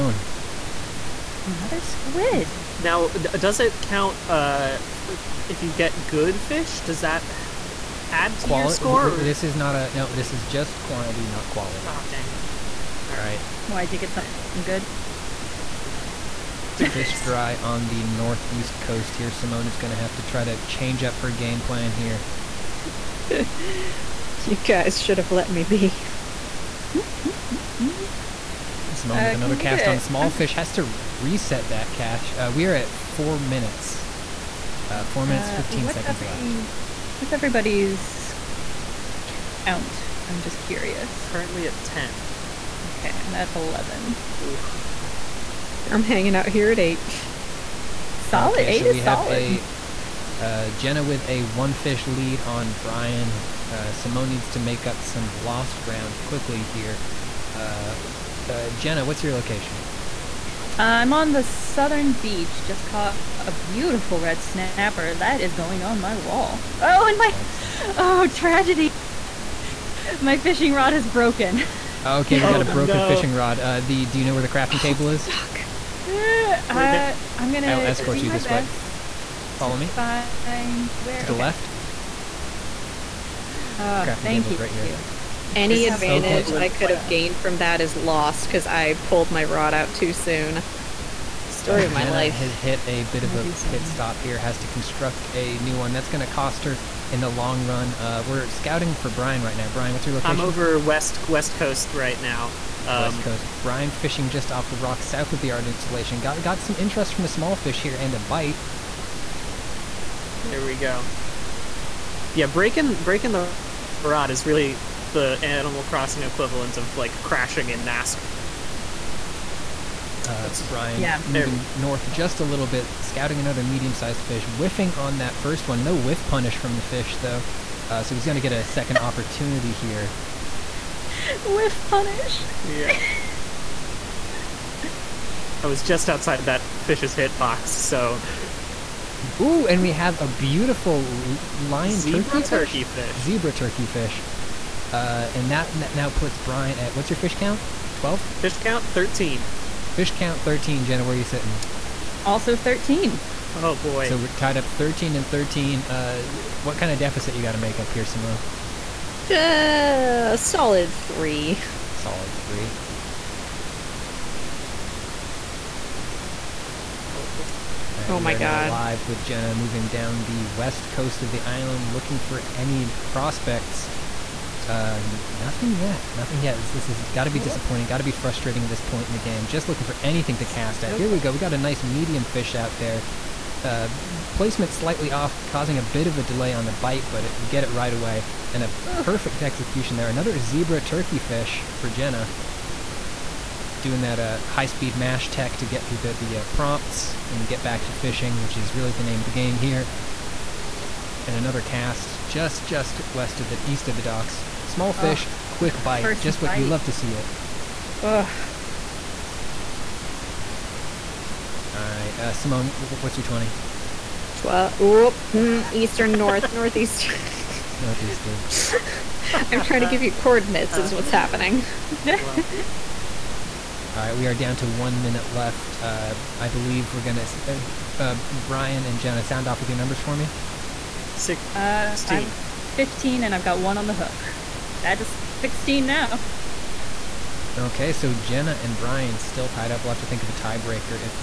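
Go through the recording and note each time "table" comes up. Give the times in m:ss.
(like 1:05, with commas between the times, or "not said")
1:14, 1:24.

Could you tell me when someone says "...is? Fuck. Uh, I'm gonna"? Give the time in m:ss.
1:15.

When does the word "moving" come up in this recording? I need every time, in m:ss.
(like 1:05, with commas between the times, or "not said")
2:01, 2:49.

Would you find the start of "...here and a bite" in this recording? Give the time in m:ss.
1:47.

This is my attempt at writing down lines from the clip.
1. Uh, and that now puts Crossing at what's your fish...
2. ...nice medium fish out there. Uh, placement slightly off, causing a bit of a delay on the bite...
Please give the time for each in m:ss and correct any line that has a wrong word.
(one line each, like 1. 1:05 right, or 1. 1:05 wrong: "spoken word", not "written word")
1. 2:24 wrong: "Brian", not "Crossing"
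2. 3:01 right.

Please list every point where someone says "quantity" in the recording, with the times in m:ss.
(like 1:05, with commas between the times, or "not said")
0:10.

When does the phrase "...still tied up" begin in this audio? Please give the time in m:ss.
3:59.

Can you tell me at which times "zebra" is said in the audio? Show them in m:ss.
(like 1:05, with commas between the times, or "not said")
2:23, 3:10.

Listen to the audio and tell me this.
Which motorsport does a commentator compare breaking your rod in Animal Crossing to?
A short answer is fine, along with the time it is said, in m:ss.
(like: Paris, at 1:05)
NASCAR, at 1:57.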